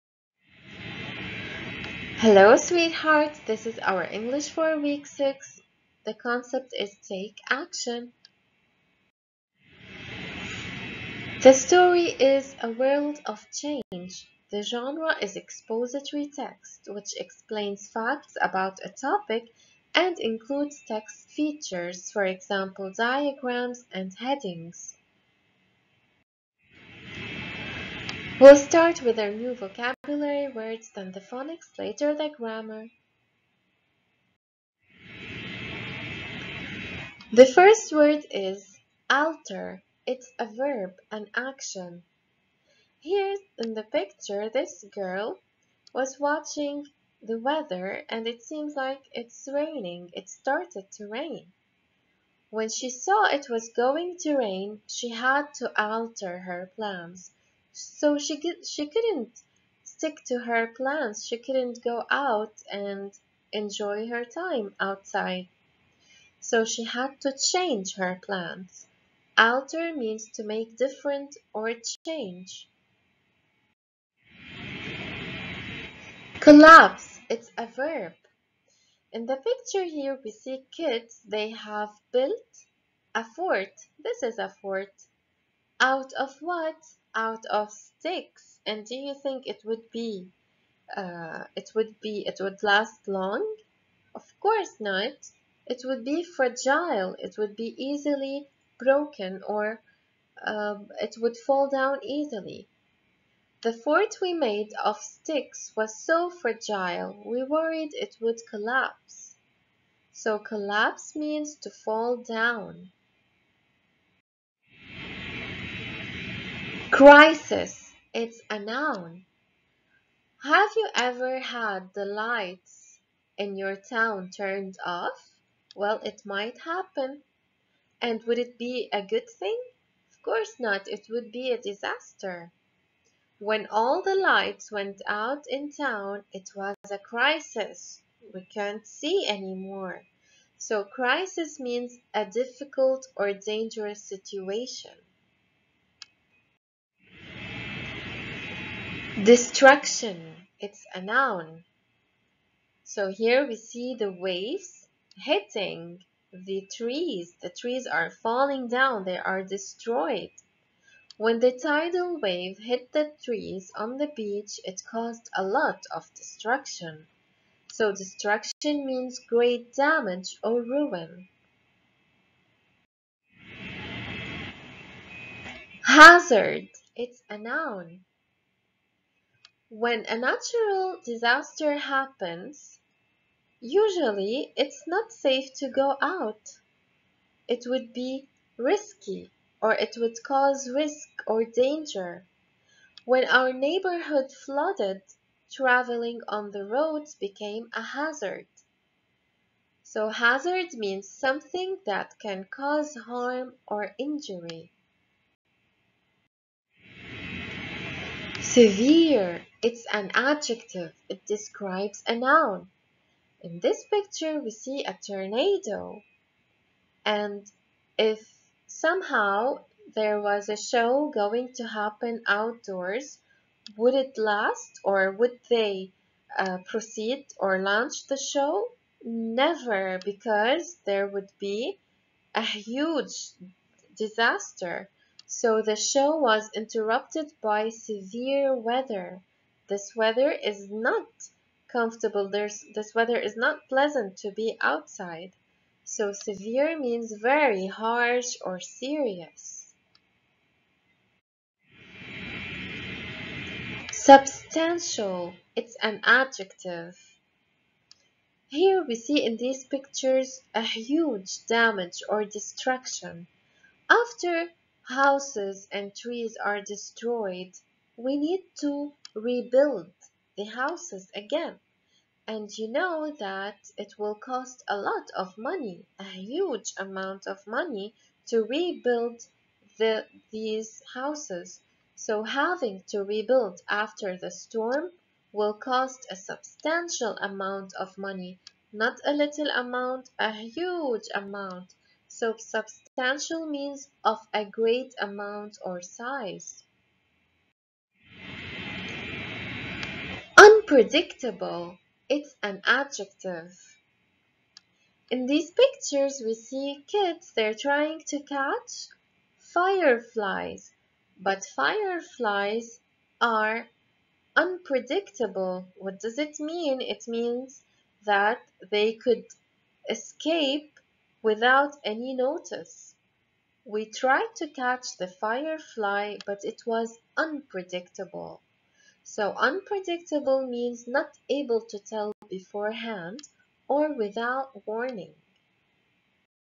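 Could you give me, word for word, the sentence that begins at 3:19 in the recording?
So hazard means something that can cause harm or injury.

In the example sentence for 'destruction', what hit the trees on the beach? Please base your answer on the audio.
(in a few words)
tidal wave.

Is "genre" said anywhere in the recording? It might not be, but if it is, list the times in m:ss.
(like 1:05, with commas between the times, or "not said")
0:14.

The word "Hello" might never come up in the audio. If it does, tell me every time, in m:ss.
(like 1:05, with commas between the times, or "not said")
0:02.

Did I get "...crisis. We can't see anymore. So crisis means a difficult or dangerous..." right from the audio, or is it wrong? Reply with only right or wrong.
right.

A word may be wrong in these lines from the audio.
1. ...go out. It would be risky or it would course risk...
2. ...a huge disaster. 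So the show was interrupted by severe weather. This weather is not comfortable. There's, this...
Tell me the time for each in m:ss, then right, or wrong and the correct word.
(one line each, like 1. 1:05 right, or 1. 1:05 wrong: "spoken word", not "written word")
1. 3:05 wrong: "cause", not "course"
2. 3:52 right.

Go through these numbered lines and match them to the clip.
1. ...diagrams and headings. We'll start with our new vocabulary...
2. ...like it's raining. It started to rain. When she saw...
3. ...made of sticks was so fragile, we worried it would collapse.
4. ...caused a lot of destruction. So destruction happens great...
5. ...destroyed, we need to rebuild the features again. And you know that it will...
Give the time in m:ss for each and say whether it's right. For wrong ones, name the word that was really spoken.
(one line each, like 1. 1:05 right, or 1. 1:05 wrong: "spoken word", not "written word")
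1. 0:22 right
2. 0:48 right
3. 1:44 right
4. 2:44 wrong: "means", not "happens"
5. 4:26 wrong: "houses", not "features".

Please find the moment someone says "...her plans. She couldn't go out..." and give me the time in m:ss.
1:00.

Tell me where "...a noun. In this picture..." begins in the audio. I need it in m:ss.
3:32.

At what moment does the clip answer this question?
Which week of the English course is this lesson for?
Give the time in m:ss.
0:04.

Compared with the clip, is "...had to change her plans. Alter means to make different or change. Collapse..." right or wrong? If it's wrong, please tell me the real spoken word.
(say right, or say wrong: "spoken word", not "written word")
right.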